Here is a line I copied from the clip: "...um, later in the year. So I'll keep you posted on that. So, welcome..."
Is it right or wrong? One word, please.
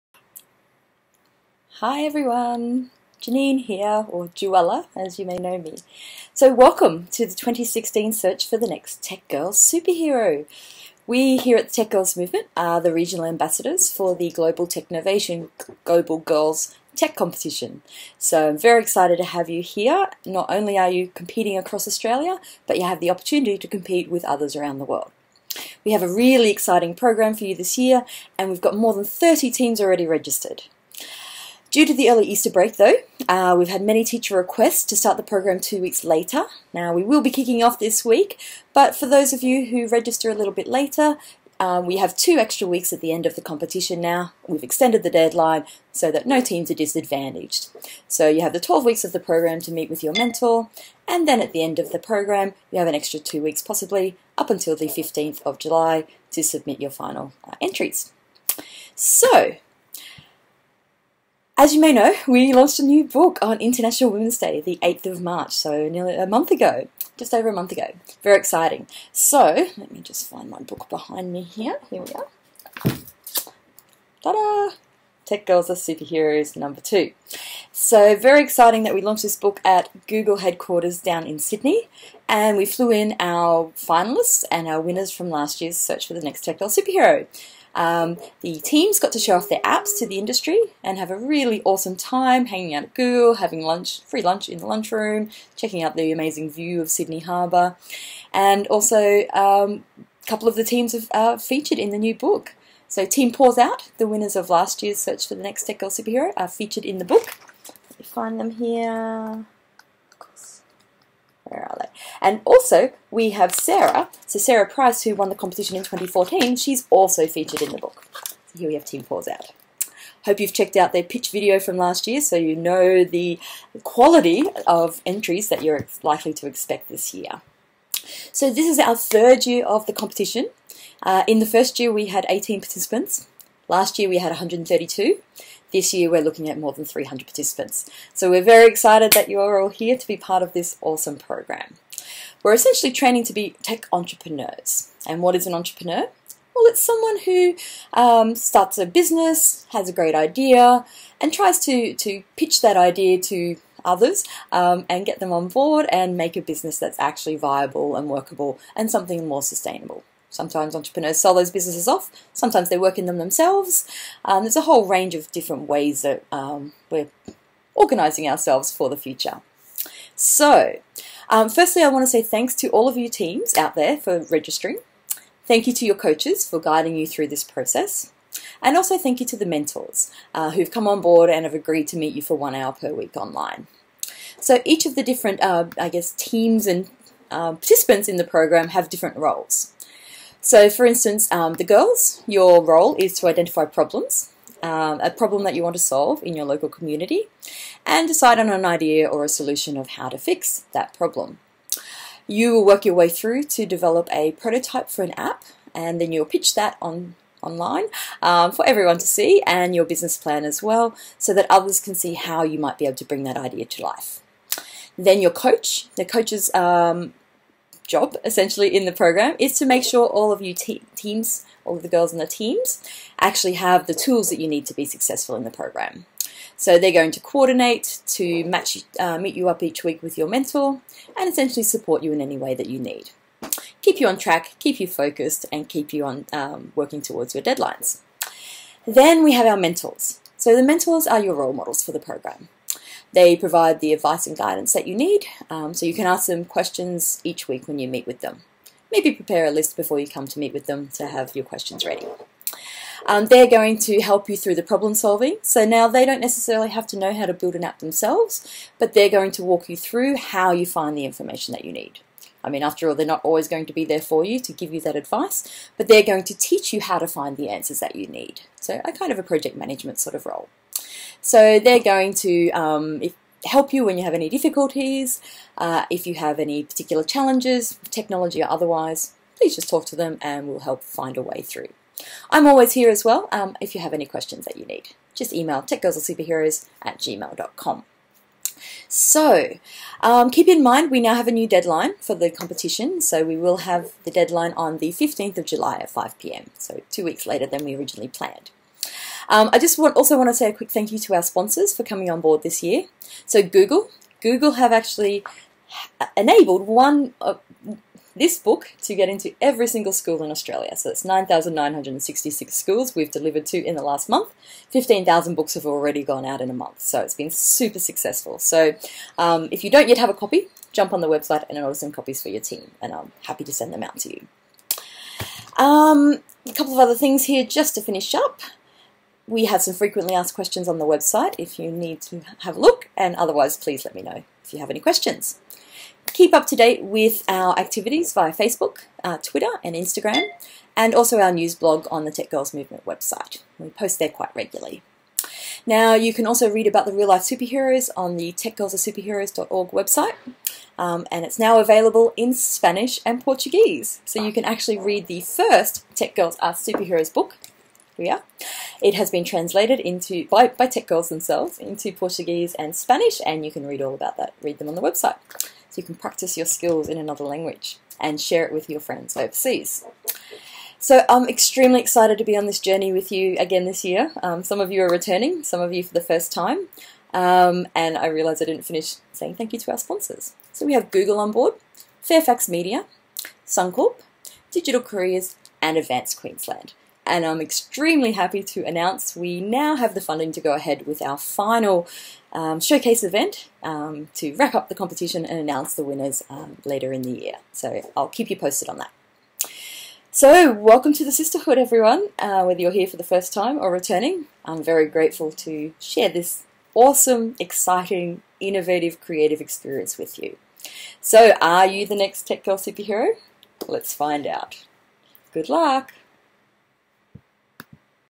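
right.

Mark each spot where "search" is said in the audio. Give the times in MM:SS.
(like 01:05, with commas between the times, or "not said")
00:08, 01:25, 01:44.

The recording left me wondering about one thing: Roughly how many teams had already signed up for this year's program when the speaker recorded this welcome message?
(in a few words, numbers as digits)
more than 30.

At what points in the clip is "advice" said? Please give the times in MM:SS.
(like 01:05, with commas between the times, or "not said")
04:03, 04:24.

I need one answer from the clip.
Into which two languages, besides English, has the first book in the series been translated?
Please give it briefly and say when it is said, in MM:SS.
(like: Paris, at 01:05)
Spanish and Portuguese, at 05:52.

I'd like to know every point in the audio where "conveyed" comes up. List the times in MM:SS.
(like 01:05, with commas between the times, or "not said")
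not said.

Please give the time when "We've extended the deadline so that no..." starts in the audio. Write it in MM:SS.
00:44.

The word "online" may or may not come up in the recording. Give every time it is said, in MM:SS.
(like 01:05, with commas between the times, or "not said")
03:03, 03:27.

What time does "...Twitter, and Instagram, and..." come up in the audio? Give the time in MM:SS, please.
05:39.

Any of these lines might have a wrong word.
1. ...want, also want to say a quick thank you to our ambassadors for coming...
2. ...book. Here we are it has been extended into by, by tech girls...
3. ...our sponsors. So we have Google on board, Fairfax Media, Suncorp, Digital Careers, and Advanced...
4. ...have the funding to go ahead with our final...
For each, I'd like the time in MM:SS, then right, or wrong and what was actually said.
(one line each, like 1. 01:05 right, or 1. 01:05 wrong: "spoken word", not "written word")
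1. 04:59 wrong: "sponsors", not "ambassadors"
2. 05:57 wrong: "translated", not "extended"
3. 06:19 right
4. 06:29 right.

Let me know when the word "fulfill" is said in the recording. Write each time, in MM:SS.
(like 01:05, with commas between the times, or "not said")
not said.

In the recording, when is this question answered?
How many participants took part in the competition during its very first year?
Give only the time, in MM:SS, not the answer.
02:12.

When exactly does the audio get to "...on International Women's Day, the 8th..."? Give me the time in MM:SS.
01:03.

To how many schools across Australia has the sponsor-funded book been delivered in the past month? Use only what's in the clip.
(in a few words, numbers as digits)
9,966.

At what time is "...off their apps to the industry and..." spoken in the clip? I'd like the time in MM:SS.
01:29.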